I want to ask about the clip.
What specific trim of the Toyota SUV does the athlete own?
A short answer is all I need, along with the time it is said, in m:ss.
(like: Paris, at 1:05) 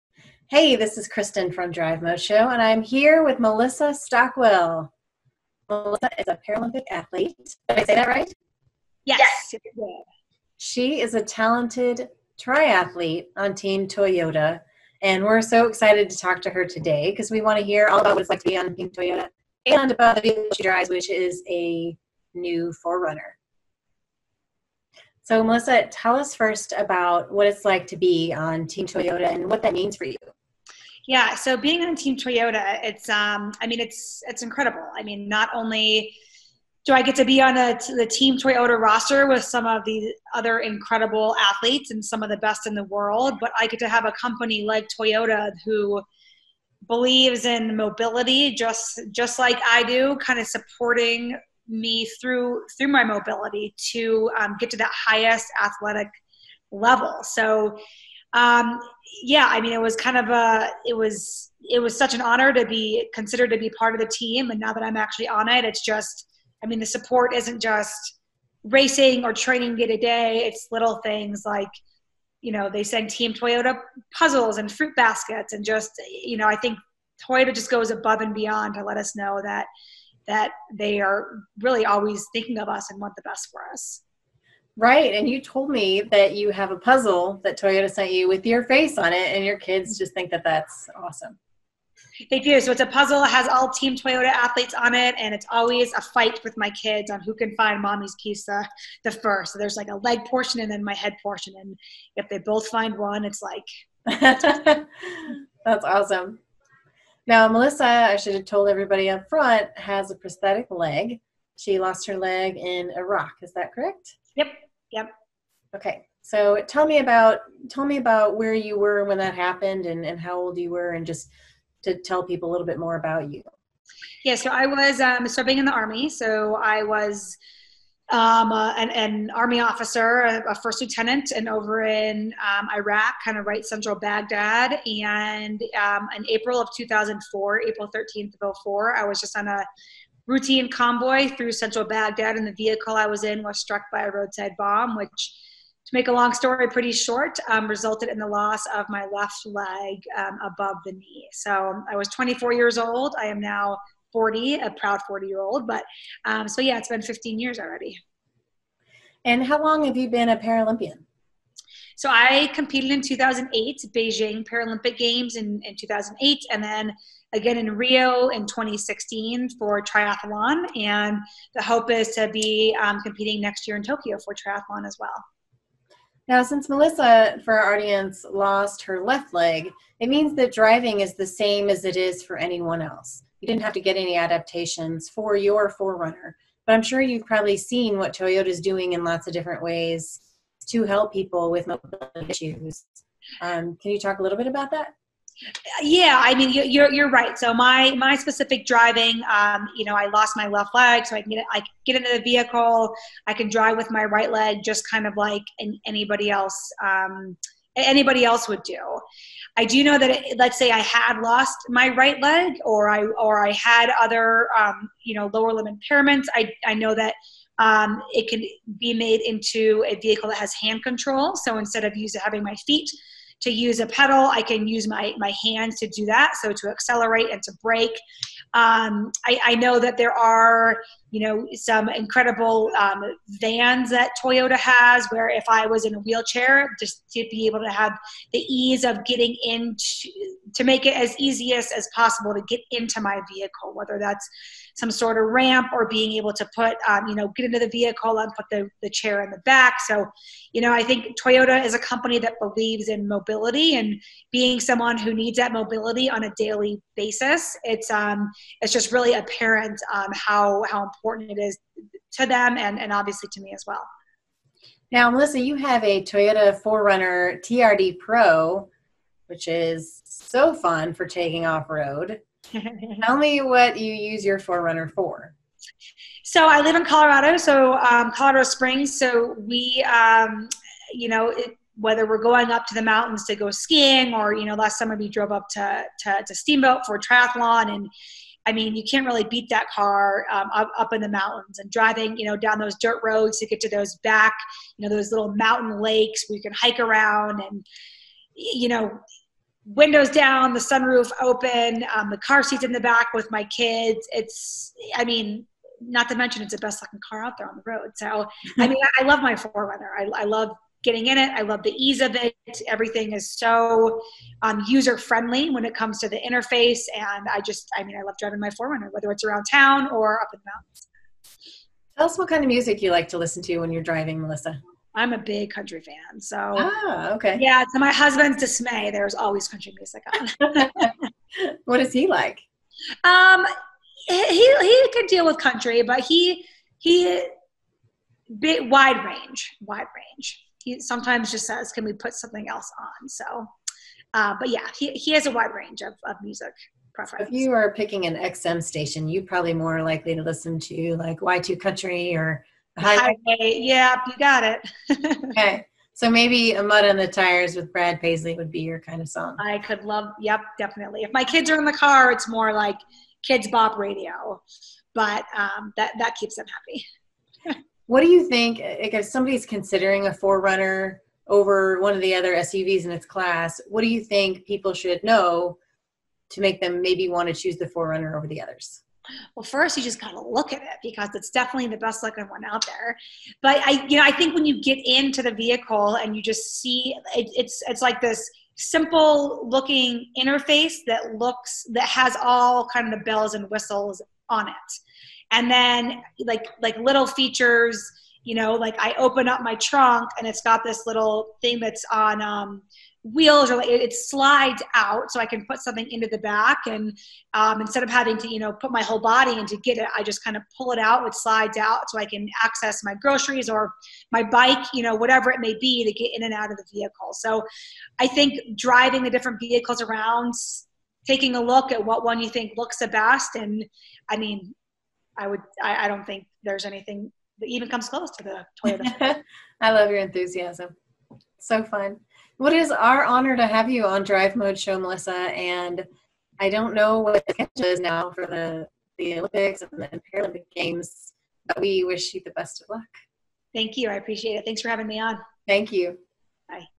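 TRD Pro, at 4:27.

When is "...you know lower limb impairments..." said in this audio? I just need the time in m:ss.
3:35.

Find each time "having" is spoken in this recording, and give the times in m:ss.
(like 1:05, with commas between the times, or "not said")
3:42, 6:47, 7:24.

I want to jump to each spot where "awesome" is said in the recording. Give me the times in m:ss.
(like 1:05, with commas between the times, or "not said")
1:30, 1:45.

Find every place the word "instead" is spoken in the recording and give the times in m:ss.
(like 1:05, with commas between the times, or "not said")
3:41, 6:47.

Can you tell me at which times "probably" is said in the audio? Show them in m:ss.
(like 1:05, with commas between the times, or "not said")
3:07, 5:49.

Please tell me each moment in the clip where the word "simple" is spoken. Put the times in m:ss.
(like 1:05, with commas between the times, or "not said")
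6:28.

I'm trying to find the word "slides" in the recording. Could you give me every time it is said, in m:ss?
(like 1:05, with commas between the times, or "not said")
6:43, 6:51.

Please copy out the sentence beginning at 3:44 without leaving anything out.
I can use my, my hands to do that, so to accelerate and to brake.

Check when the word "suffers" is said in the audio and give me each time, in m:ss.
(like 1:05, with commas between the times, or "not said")
not said.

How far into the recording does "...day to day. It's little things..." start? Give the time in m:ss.
1:09.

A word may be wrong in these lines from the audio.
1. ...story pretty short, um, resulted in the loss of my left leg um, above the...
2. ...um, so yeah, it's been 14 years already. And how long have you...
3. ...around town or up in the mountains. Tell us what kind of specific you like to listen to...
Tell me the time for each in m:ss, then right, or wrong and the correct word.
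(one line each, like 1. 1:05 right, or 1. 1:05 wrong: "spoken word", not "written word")
1. 2:26 right
2. 2:36 wrong: "15", not "14"
3. 5:19 wrong: "music", not "specific".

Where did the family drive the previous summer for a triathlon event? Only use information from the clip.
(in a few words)
Steamboat.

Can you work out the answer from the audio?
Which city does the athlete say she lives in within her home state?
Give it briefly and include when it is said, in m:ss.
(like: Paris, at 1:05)
Colorado Springs, at 4:38.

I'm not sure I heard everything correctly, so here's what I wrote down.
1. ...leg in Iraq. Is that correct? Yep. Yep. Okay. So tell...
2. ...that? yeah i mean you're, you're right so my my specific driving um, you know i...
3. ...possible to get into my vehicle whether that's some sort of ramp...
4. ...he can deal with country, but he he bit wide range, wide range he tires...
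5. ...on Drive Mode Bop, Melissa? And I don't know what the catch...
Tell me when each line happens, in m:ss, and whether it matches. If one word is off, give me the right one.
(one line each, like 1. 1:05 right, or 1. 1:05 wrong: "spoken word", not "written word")
1. 1:52 right
2. 3:14 right
3. 4:01 right
4. 5:34 wrong: "sometimes", not "tires"
5. 7:13 wrong: "Show", not "Bop".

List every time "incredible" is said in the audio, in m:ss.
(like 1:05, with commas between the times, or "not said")
0:34, 0:40, 3:51.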